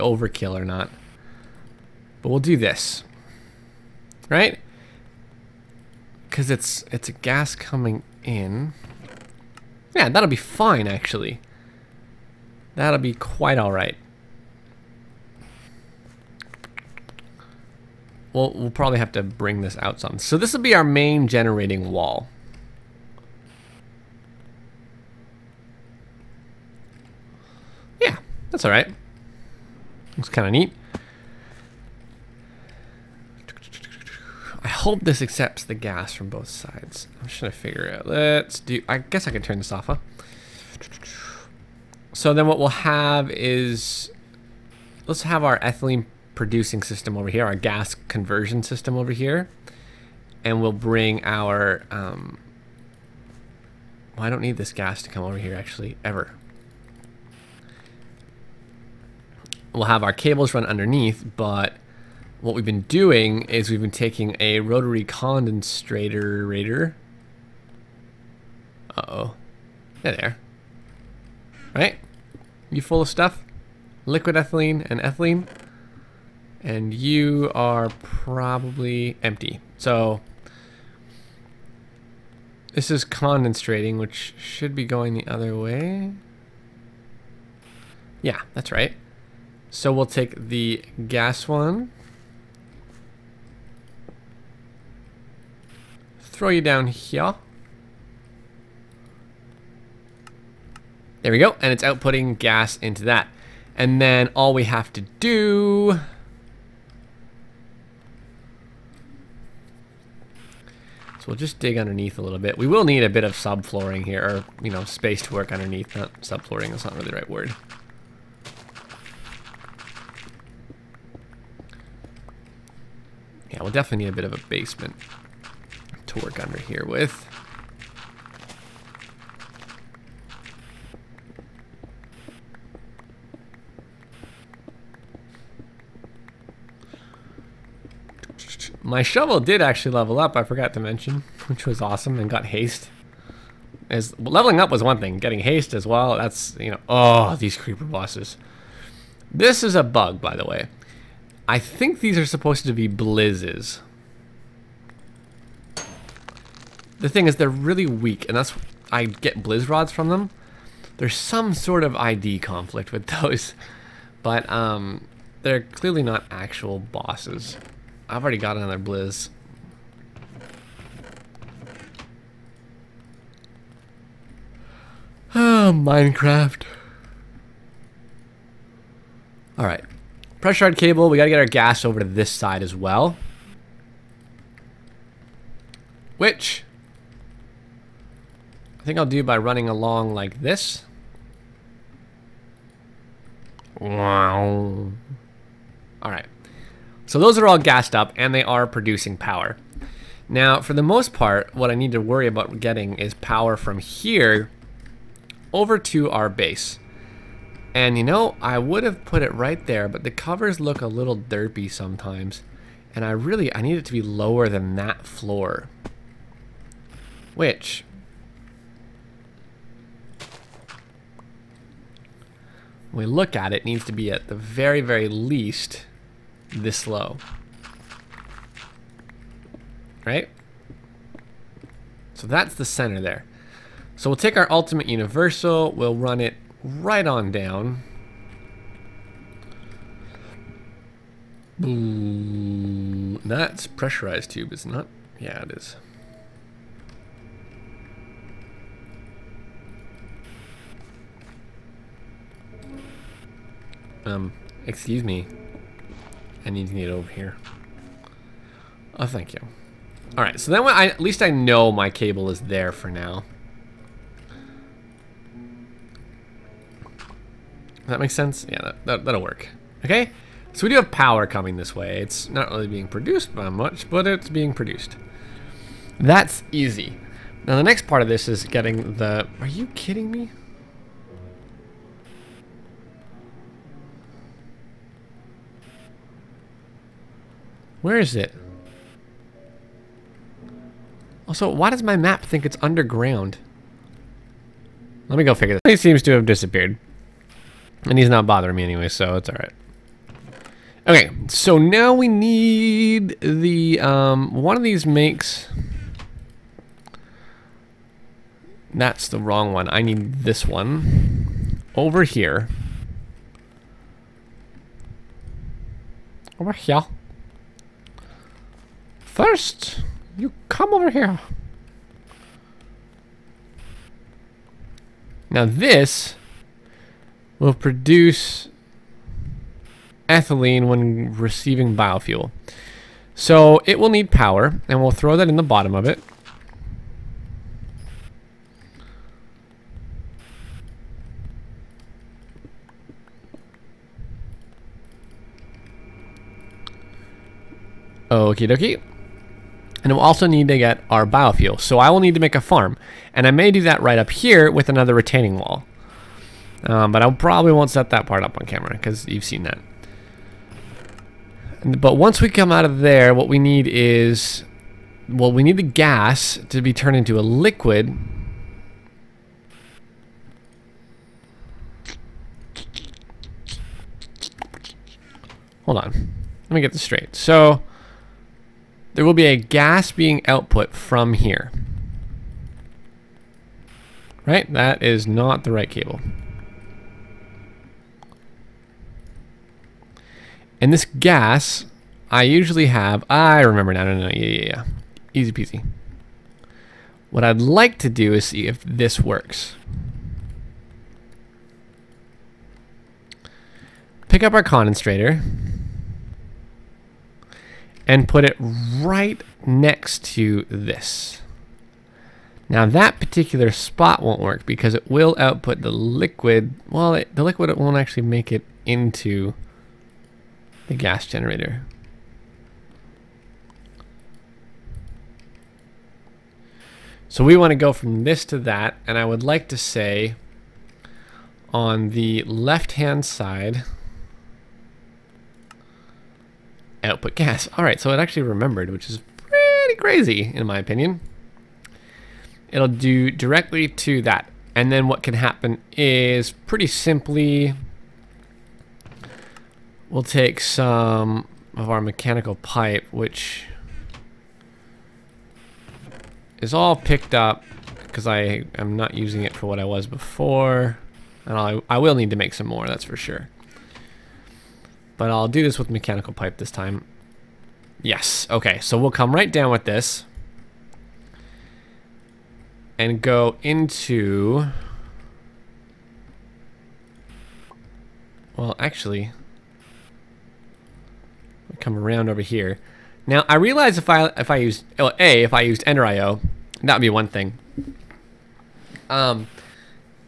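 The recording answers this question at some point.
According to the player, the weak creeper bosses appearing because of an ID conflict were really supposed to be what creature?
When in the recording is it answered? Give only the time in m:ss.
2:32.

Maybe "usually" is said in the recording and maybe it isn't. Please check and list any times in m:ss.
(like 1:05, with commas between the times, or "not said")
6:32.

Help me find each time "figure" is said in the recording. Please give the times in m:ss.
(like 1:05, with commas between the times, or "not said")
0:37, 4:55.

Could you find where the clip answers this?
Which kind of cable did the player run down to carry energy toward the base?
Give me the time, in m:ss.
3:54.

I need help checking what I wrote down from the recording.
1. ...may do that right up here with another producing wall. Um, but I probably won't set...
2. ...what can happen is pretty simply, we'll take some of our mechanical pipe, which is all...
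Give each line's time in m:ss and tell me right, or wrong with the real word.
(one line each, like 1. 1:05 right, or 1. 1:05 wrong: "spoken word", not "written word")
1. 5:53 wrong: "retaining", not "producing"
2. 7:24 right.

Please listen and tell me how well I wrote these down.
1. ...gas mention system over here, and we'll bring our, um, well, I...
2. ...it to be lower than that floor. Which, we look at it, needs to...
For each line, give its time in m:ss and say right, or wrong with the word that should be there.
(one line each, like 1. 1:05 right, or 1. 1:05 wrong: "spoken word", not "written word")
1. 0:47 wrong: "conversion", not "mention"
2. 3:33 right.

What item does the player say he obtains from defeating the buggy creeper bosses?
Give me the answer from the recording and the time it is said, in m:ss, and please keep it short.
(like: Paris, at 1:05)
Blizz rods, at 2:39.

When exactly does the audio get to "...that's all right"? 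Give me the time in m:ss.
0:28.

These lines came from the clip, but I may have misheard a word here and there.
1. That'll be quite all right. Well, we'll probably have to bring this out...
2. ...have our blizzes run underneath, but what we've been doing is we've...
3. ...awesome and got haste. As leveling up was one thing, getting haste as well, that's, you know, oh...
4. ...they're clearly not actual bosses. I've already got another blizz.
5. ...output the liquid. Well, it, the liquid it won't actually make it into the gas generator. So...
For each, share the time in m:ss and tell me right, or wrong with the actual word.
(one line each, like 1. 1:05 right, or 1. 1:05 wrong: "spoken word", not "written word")
1. 0:12 right
2. 0:59 wrong: "cables", not "blizzes"
3. 2:21 right
4. 2:45 right
5. 6:55 right.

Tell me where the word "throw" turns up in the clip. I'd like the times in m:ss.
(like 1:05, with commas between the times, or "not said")
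1:36, 5:34.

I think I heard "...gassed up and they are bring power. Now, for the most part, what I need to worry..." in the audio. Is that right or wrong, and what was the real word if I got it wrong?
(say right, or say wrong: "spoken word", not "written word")
wrong: "producing", not "bring".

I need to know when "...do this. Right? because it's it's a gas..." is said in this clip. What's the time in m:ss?
0:02.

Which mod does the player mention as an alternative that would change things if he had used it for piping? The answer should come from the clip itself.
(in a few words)
Ender IO.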